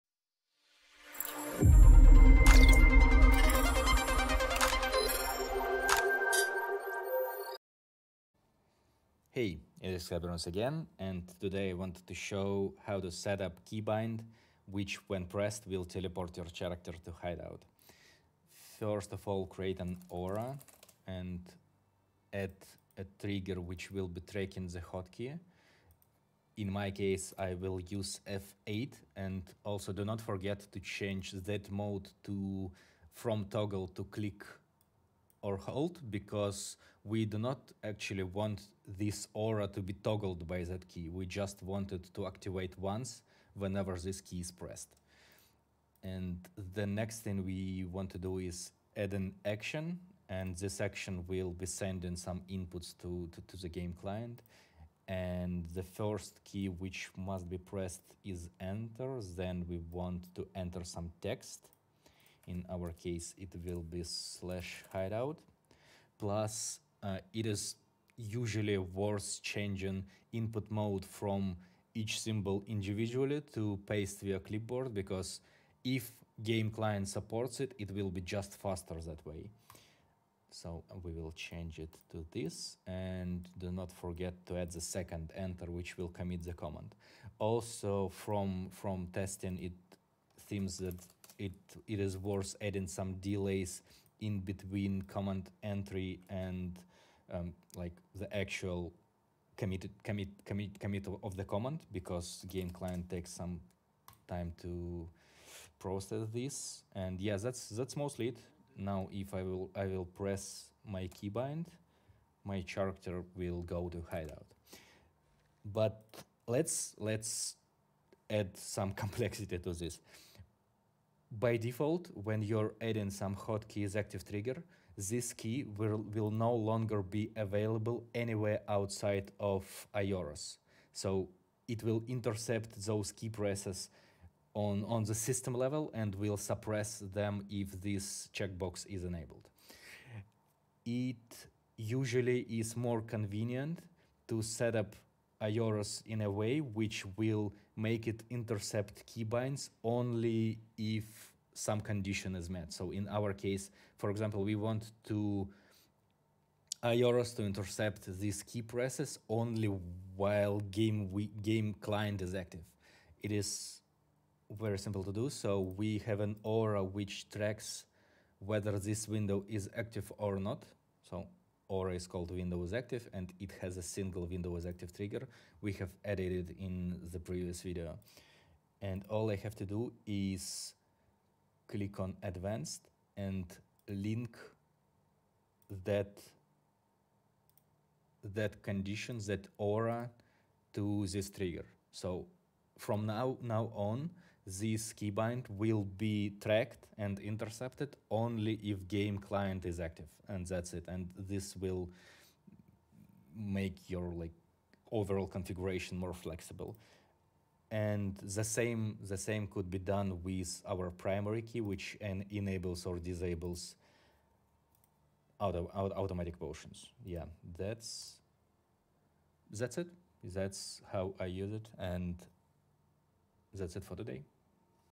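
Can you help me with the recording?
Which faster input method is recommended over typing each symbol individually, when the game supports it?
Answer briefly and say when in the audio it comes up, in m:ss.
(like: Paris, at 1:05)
Paste via clipboard, at 1:13.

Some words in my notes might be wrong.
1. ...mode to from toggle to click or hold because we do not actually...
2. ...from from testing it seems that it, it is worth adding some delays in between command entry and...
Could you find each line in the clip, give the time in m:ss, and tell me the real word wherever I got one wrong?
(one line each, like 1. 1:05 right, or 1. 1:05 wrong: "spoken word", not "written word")
1. 0:31 right
2. 1:28 right.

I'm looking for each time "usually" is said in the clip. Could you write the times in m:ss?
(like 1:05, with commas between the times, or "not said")
1:08, 2:21.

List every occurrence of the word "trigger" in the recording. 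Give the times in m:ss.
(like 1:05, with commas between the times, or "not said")
0:23, 2:04, 2:54, 3:11.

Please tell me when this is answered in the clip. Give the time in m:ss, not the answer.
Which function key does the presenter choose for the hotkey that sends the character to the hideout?
0:28.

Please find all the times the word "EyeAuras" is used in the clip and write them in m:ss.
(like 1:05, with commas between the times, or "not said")
2:09, 2:25, 2:36.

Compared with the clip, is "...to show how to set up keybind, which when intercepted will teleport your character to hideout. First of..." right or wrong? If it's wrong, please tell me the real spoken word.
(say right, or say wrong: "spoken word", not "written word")
wrong: "pressed", not "intercepted".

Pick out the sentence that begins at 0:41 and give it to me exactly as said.
We just want it to activate once whenever this key is pressed.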